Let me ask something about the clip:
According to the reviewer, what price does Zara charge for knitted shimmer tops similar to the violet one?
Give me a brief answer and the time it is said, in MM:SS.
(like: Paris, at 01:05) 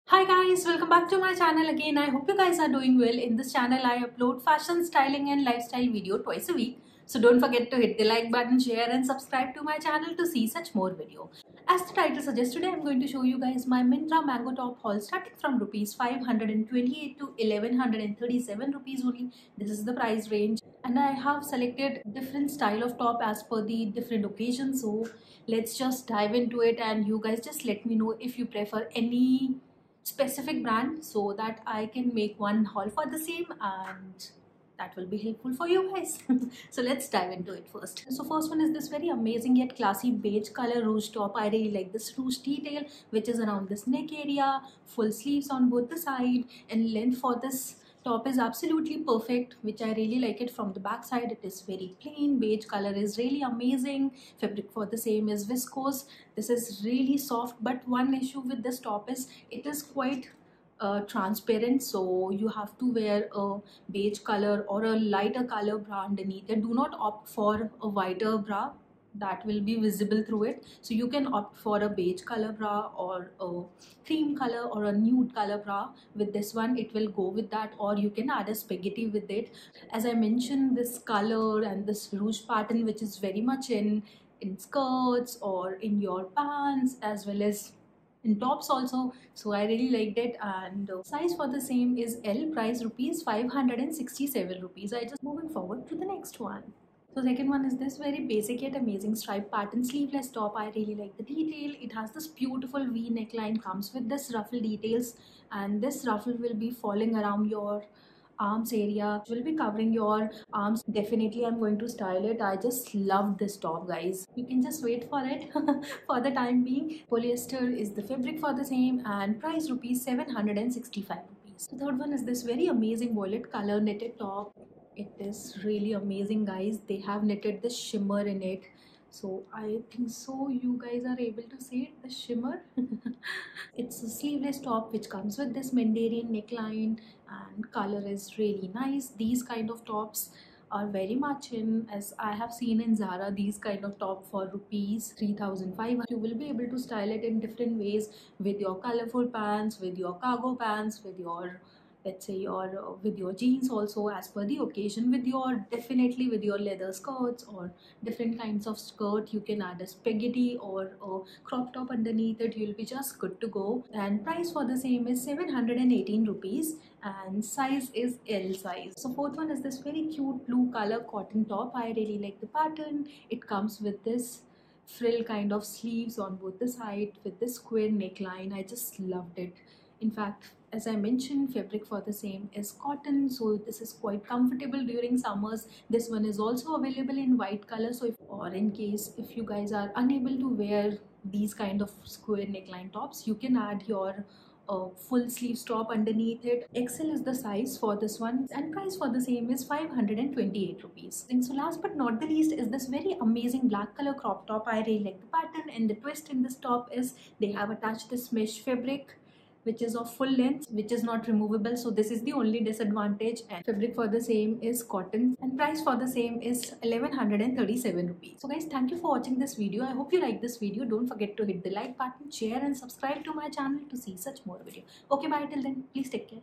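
3500 rupees, at 02:24.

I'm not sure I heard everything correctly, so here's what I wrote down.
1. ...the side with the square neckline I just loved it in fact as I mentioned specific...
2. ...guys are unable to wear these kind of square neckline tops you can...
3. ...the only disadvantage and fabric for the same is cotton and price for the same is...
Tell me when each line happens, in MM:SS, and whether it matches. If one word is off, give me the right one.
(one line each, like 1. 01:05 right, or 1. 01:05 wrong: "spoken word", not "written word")
1. 02:56 wrong: "fabric", not "specific"
2. 03:09 right
3. 03:32 right.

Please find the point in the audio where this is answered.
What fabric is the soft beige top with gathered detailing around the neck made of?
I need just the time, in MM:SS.
00:55.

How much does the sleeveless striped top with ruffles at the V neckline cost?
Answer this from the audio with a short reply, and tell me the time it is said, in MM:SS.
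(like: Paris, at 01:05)
765 rupees, at 01:59.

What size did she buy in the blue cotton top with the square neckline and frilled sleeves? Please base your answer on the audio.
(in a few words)
XL.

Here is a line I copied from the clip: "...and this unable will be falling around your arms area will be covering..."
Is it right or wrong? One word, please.
wrong.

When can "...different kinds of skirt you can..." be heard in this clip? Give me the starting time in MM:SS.
02:38.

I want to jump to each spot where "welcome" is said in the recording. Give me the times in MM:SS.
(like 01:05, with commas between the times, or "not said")
00:00.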